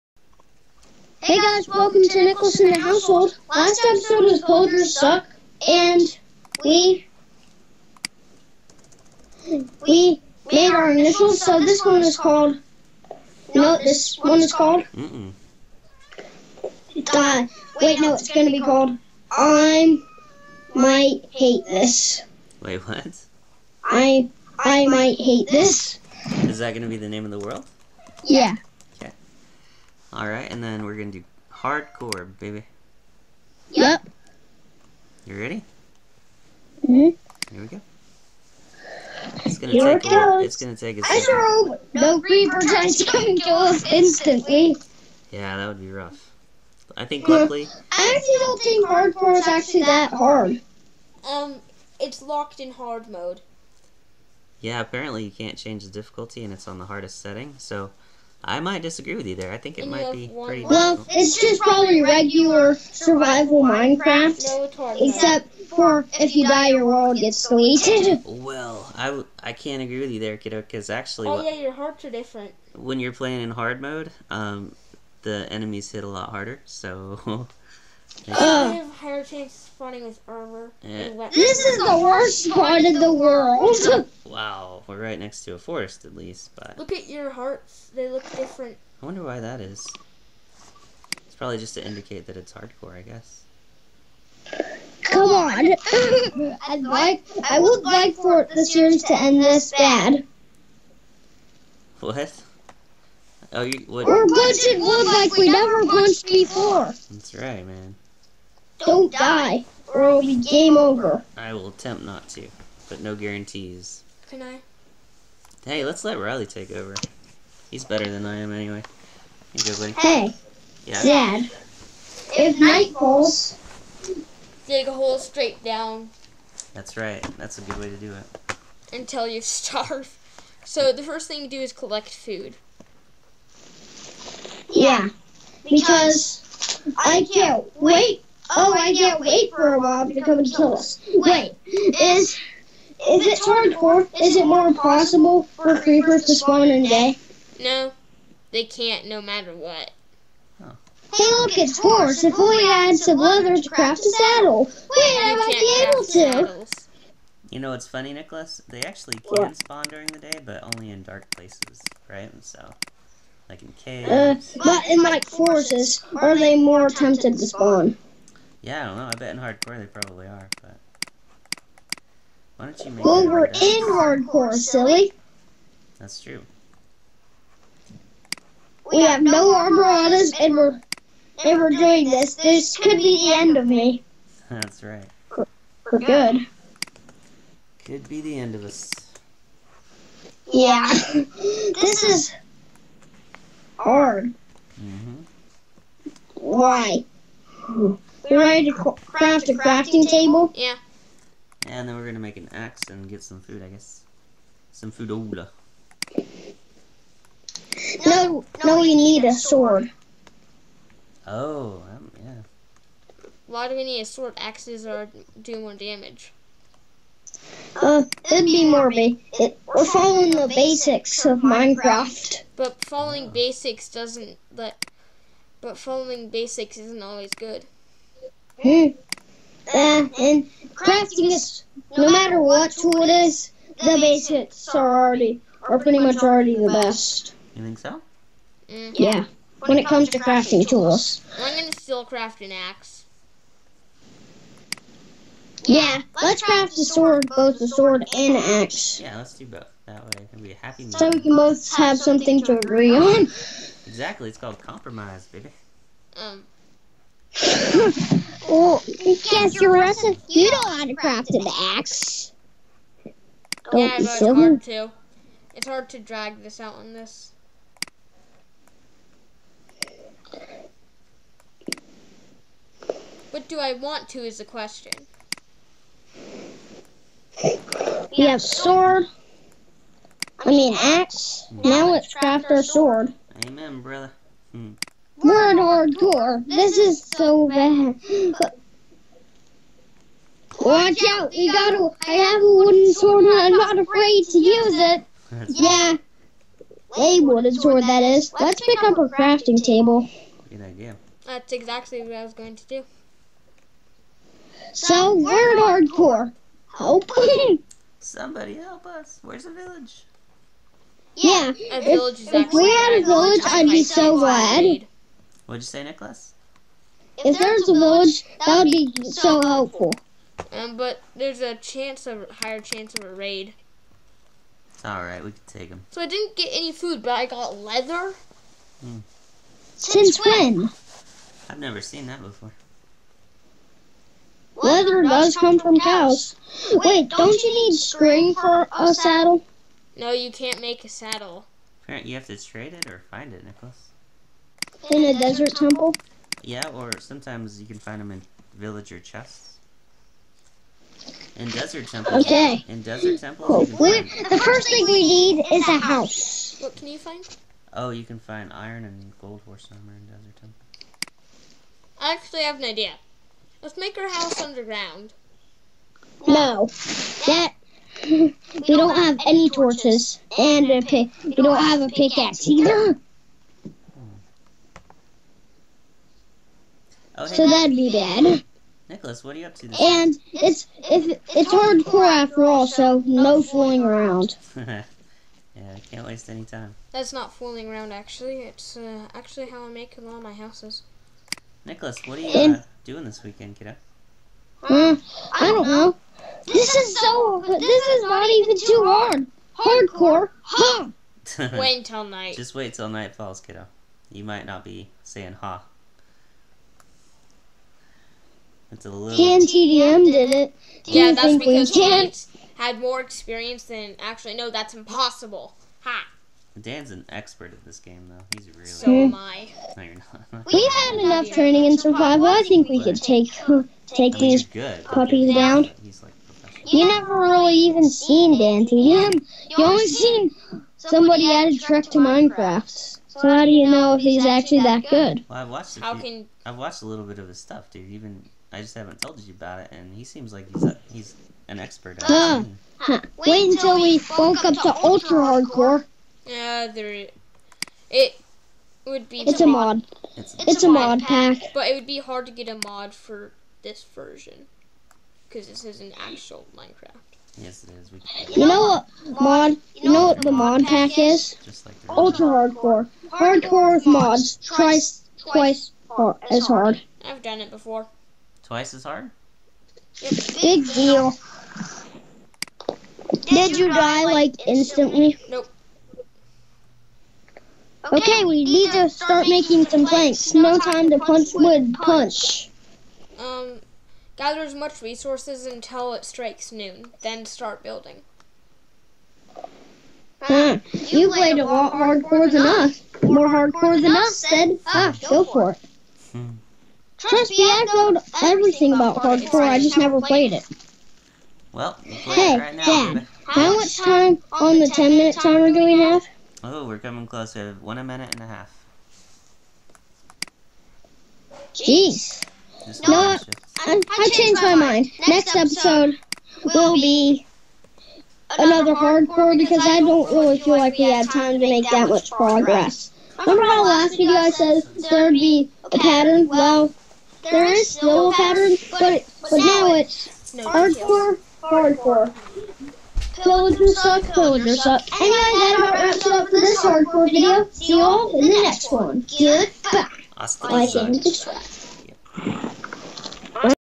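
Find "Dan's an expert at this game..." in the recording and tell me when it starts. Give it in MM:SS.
06:56.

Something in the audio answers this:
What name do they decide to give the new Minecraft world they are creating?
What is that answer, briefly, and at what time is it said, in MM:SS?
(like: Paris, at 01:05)
I might hate this, at 00:23.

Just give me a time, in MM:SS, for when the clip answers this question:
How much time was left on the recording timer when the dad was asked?
08:27.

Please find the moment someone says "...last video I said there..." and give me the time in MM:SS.
08:43.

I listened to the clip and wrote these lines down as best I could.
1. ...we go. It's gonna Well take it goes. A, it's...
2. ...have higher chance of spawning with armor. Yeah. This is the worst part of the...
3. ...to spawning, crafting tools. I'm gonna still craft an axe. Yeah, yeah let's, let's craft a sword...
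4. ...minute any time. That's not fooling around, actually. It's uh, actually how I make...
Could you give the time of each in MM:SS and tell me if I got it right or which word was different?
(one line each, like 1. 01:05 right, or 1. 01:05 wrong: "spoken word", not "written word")
1. 00:37 wrong: "Here", not "Well"
2. 01:18 right
3. 04:00 wrong: "crafting", not "spawning"
4. 06:26 wrong: "waste", not "minute".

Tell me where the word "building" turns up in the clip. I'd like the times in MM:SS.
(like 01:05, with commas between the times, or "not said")
08:07.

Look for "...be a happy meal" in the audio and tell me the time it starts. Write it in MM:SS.
04:10.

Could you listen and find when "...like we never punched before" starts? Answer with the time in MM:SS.
01:45.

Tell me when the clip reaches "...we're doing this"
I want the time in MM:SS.
03:01.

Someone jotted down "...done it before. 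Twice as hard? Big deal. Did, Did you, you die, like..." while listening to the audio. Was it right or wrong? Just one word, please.
right.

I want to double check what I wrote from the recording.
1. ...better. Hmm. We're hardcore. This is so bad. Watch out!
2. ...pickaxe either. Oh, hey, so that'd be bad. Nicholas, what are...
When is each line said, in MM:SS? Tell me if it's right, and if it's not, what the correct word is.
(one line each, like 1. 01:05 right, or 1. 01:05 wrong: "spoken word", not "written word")
1. 04:43 wrong: "brother", not "better"
2. 06:11 right.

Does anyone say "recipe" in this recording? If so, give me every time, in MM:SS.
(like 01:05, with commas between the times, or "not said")
04:19.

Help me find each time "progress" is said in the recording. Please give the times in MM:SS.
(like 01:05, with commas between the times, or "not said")
08:42.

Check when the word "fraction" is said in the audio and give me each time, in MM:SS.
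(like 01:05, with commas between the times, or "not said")
not said.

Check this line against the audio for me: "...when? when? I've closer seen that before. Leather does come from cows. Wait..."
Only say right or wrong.
wrong.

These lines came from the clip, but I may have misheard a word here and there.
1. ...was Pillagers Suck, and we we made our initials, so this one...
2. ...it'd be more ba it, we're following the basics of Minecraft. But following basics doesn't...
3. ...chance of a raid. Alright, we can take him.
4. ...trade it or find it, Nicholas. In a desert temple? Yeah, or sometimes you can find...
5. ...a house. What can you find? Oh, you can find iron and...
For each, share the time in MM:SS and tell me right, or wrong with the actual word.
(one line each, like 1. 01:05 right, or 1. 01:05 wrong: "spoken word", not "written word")
1. 00:04 right
2. 03:38 right
3. 05:22 right
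4. 05:42 right
5. 05:55 right.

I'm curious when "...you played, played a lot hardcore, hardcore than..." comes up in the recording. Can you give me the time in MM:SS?
08:11.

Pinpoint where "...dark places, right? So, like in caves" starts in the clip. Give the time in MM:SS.
02:41.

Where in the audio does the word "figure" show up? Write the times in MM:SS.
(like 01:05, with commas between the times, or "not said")
not said.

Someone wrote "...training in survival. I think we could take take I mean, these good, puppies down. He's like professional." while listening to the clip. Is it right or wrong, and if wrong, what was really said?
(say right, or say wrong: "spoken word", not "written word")
right.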